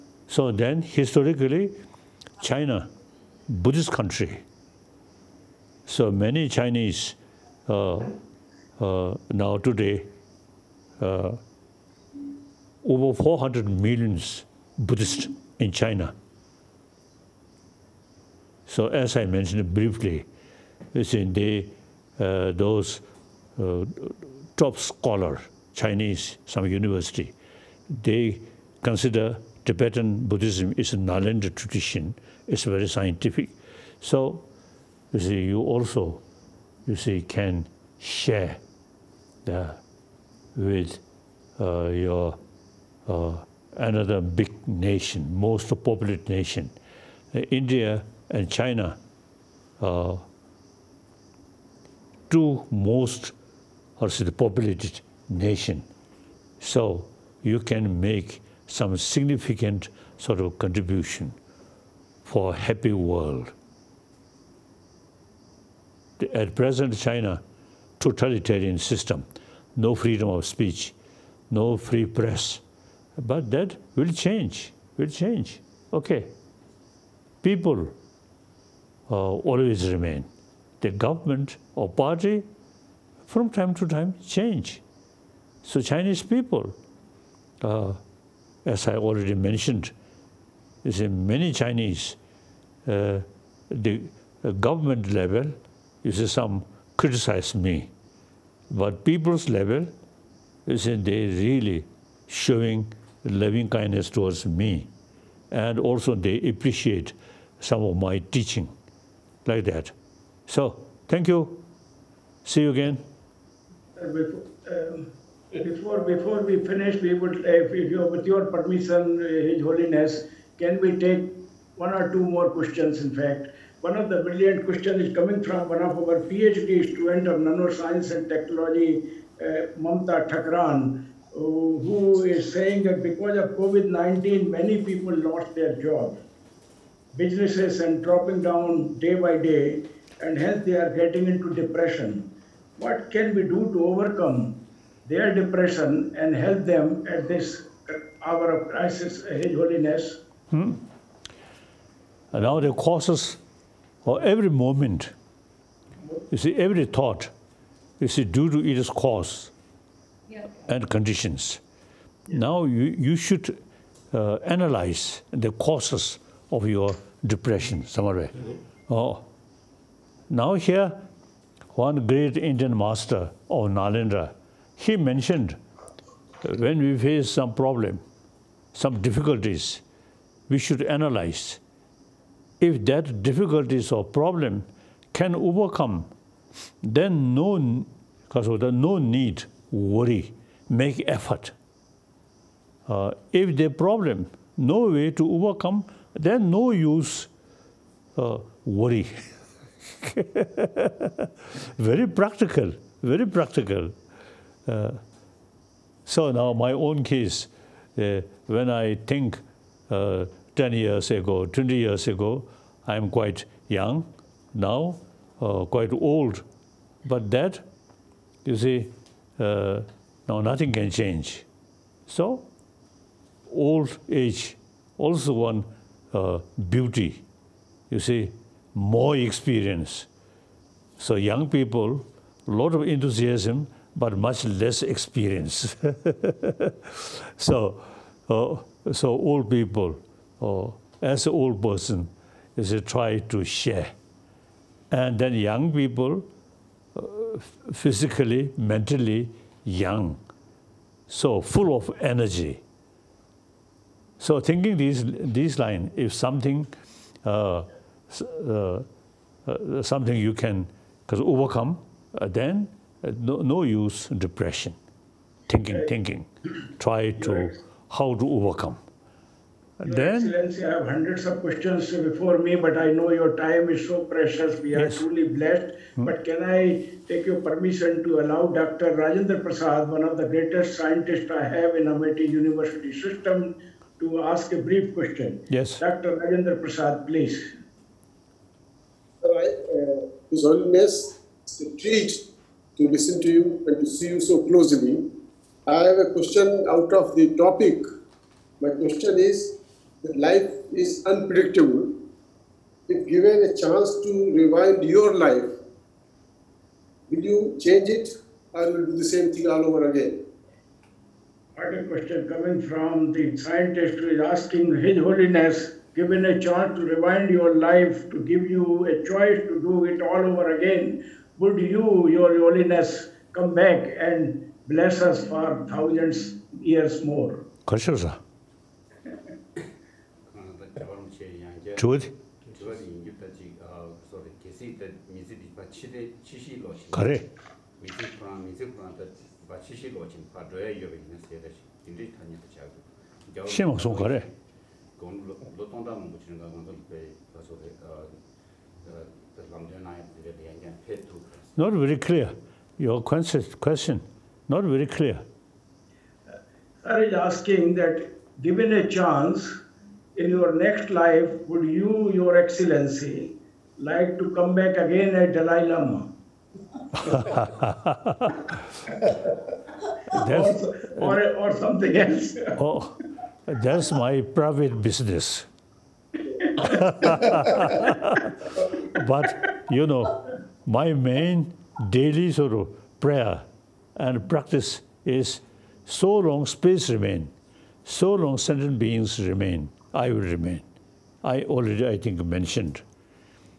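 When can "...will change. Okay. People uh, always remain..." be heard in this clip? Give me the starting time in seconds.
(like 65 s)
74 s.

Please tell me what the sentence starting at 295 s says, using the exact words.
I have a question out of the topic.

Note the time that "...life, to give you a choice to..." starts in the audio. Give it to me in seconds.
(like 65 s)
317 s.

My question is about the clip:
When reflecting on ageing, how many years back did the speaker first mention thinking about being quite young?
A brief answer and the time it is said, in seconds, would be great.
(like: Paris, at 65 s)
10 years, at 210 s.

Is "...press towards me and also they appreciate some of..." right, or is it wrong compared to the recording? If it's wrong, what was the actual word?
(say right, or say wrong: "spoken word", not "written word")
wrong: "kindness", not "press".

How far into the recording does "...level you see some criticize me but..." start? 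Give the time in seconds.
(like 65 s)
95 s.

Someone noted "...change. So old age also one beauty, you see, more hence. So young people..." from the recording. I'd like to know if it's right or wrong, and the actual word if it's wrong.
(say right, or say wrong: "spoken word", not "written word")
wrong: "experience", not "hence".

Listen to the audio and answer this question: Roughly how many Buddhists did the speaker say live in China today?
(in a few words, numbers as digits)
over 400 million.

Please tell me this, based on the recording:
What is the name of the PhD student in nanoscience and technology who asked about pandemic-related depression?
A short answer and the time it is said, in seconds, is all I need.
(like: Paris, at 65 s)
Mamta Thakran, at 129 s.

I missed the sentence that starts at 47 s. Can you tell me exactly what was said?
Uh, India and China, uh, two most the populated nation.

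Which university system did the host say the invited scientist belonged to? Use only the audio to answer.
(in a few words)
Amity University.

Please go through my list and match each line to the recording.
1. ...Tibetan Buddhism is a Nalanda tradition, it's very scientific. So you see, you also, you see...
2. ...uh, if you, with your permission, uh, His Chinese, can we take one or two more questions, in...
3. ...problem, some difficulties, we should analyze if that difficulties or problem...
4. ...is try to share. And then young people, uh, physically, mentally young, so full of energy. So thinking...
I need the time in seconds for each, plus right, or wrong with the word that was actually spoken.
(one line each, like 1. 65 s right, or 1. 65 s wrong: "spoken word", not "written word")
1. 29 s right
2. 117 s wrong: "Holiness", not "Chinese"
3. 177 s right
4. 242 s right.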